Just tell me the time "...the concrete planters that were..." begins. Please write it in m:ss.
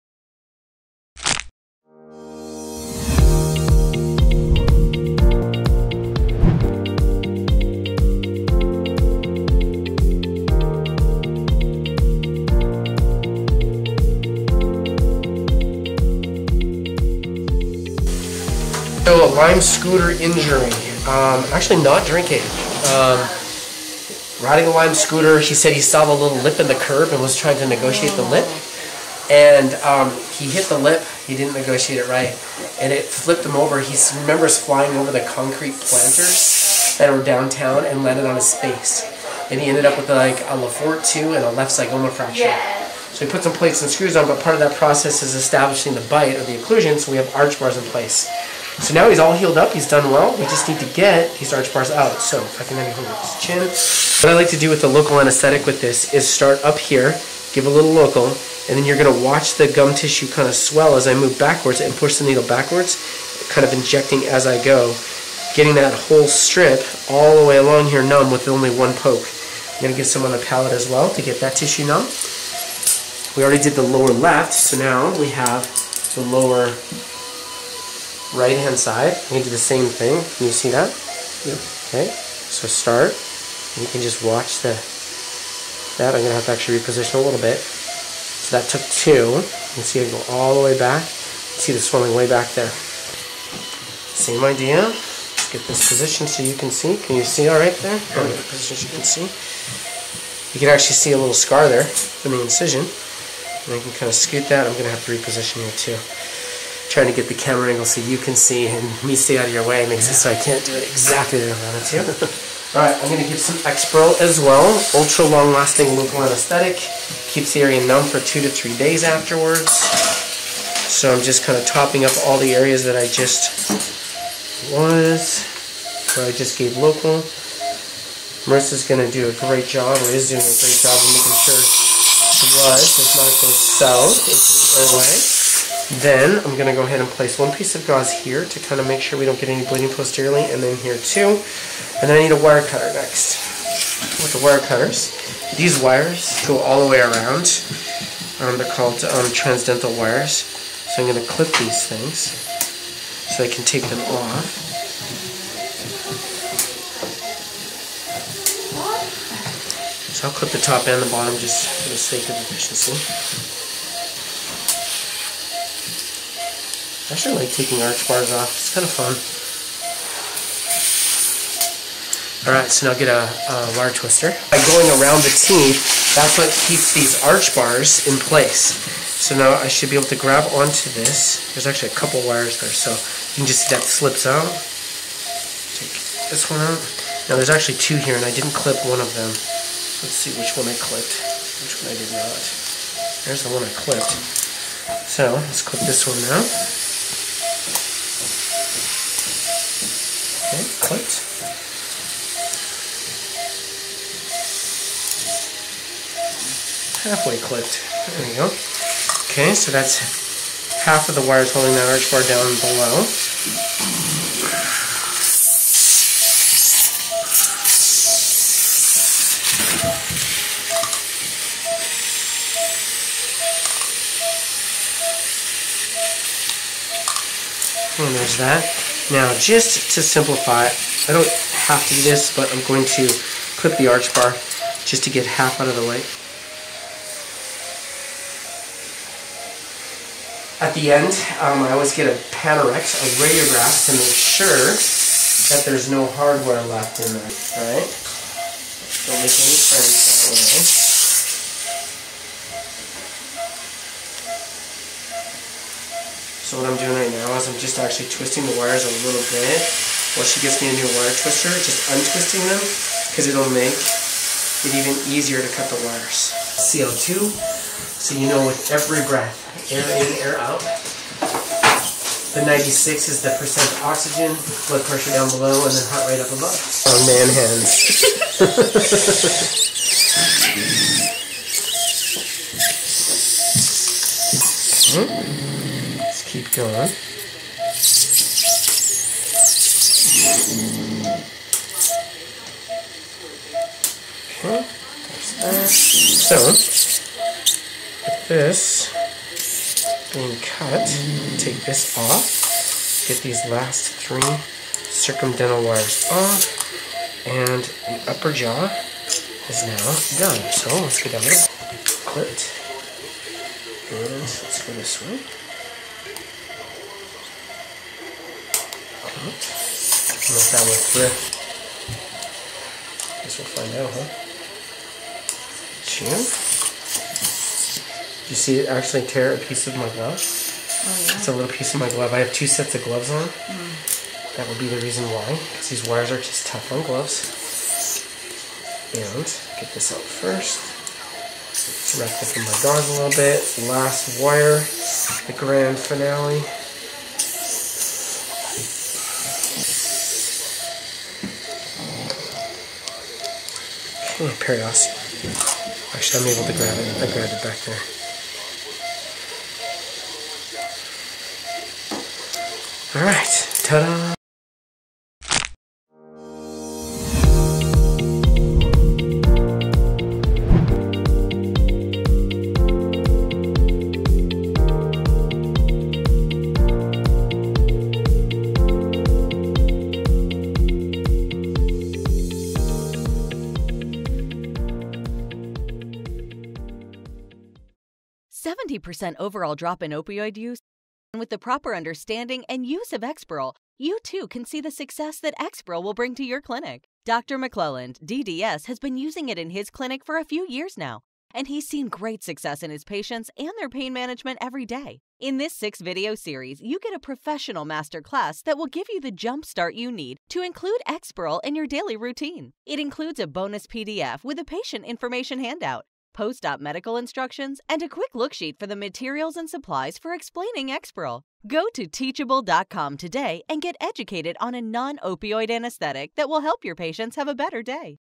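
0:35.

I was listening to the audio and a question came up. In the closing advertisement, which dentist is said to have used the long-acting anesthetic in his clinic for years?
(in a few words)
Dr. McLelland.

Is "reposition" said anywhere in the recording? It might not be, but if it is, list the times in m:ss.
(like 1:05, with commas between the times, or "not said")
1:26, 1:45.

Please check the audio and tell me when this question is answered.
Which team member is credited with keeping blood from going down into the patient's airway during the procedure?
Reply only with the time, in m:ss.
2:08.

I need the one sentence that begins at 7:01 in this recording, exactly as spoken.
Go to teachable.com today and get educated on a non-opioid anesthetic that will help your patients have a better day.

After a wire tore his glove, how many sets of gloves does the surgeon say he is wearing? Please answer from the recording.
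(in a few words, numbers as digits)
2 sets.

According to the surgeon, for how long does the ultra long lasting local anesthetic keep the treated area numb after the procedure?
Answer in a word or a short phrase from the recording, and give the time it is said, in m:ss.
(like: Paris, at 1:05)
2 to 3 days, at 1:58.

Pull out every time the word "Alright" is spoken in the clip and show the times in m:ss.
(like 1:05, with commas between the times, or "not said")
1:52, 2:52, 4:07, 6:03.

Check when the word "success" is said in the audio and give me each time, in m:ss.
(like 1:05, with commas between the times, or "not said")
6:34, 6:42.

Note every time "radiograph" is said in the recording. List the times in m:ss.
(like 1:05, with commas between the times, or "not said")
4:03.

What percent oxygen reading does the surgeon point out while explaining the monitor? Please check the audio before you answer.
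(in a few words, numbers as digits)
96.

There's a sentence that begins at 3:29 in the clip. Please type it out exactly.
Okay, so that's half of the wires holding that arch bar down below.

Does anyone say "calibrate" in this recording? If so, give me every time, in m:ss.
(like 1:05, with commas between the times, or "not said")
not said.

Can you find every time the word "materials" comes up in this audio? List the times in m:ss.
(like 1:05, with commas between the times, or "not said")
6:58.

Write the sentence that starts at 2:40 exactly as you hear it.
So I'll clip the top and the bottom just for the sake of efficiency.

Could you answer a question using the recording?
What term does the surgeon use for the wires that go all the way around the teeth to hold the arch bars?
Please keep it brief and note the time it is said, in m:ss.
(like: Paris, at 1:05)
transdental wires, at 2:29.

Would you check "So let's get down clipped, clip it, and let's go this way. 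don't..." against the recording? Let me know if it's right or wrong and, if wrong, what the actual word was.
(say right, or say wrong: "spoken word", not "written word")
right.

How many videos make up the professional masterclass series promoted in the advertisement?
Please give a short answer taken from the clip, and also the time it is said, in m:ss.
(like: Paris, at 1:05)
6, at 6:45.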